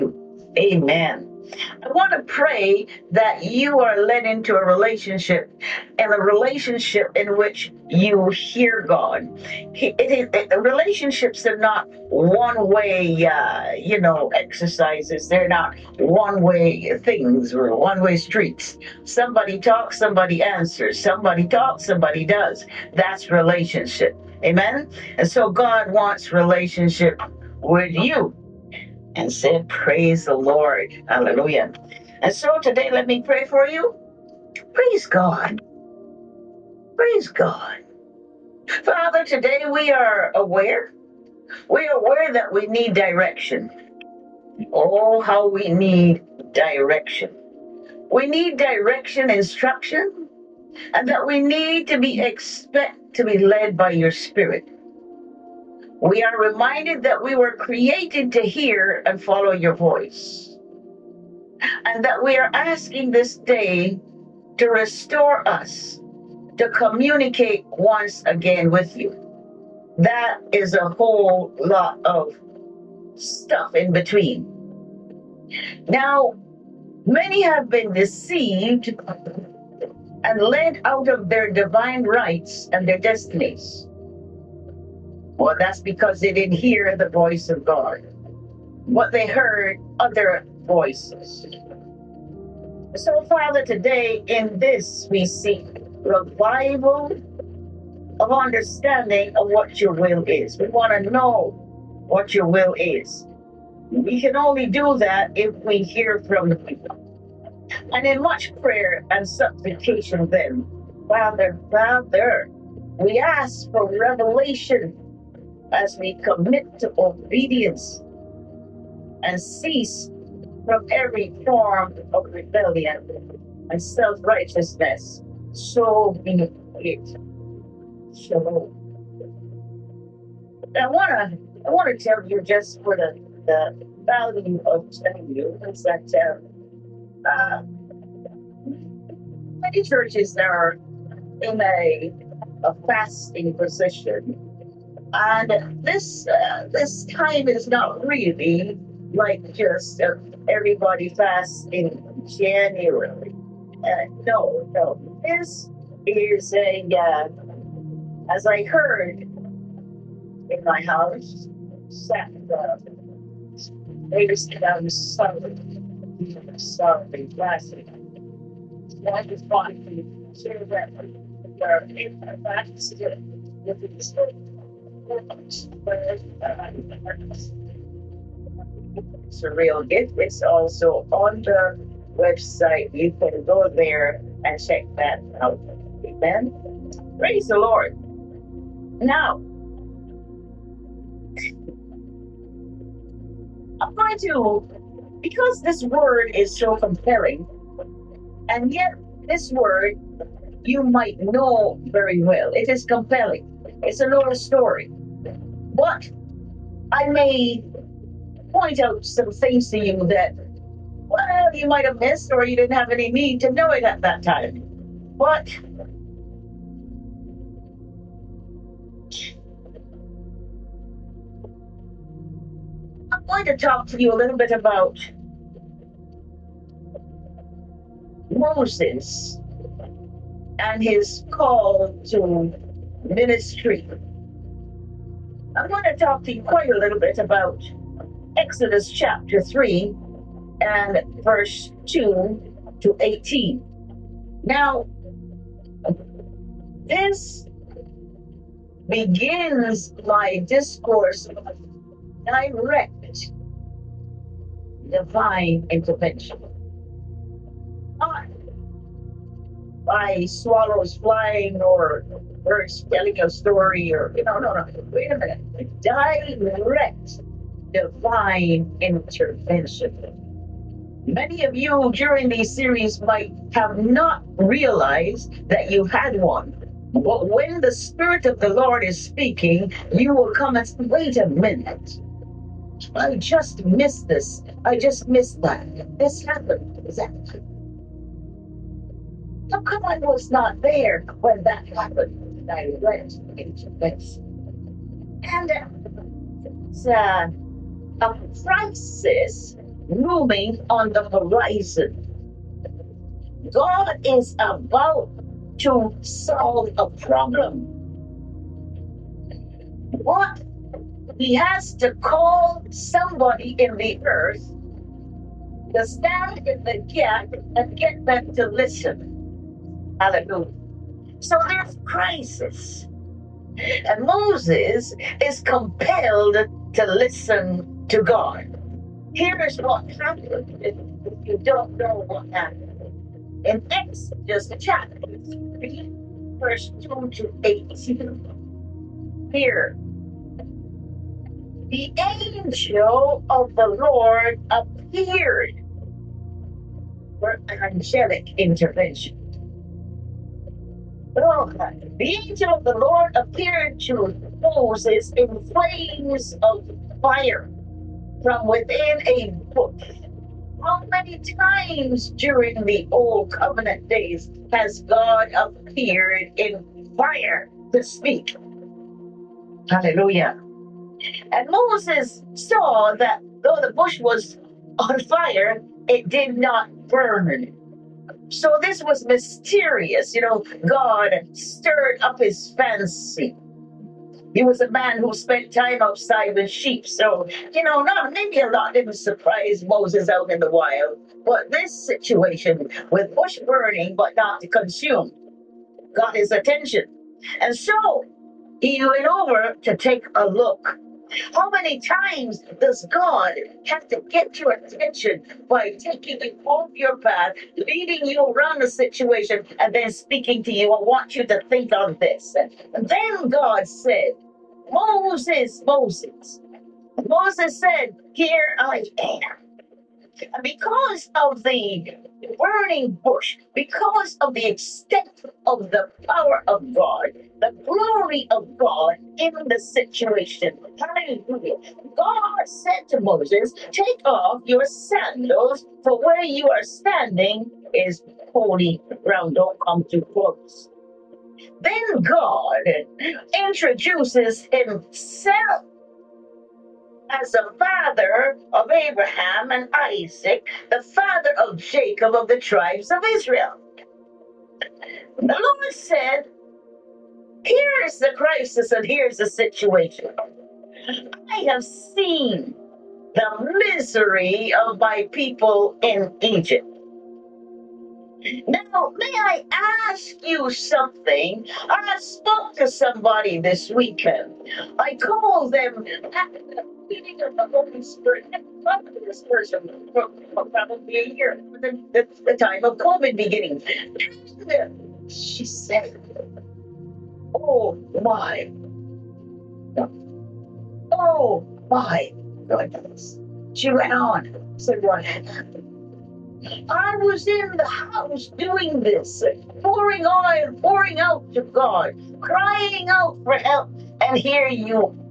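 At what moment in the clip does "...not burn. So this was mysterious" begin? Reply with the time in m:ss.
6:16.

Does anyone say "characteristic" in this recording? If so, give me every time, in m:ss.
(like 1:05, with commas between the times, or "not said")
not said.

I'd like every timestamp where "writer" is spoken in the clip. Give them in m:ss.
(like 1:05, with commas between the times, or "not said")
not said.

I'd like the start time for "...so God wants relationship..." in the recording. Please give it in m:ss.
0:25.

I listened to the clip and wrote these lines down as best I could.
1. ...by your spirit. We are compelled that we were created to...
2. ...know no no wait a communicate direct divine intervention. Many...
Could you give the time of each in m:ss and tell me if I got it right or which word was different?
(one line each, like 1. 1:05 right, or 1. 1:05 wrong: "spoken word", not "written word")
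1. 0:53 wrong: "reminded", not "compelled"
2. 4:24 wrong: "minute", not "communicate".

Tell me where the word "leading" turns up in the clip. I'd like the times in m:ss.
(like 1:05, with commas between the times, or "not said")
6:47.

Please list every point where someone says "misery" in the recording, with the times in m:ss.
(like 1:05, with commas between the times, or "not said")
7:43.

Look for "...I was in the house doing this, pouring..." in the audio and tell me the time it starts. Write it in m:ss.
8:16.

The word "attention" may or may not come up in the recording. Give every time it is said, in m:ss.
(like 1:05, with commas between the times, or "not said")
6:36, 6:44.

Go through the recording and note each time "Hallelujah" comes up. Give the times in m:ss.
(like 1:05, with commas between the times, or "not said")
0:31, 5:20, 6:09, 7:10.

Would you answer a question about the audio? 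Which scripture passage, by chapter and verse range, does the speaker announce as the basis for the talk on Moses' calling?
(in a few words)
Exodus 3:2-18.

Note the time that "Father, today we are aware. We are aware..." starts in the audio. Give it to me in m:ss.
0:38.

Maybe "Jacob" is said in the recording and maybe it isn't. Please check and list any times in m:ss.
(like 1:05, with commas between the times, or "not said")
7:31.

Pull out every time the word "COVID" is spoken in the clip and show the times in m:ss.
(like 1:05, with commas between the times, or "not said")
8:02.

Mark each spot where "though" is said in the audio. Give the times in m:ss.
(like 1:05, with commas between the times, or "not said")
6:13.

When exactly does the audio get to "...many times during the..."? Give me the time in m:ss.
6:00.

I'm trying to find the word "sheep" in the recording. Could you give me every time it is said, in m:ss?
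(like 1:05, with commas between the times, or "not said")
6:26.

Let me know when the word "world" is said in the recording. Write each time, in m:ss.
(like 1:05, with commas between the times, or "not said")
not said.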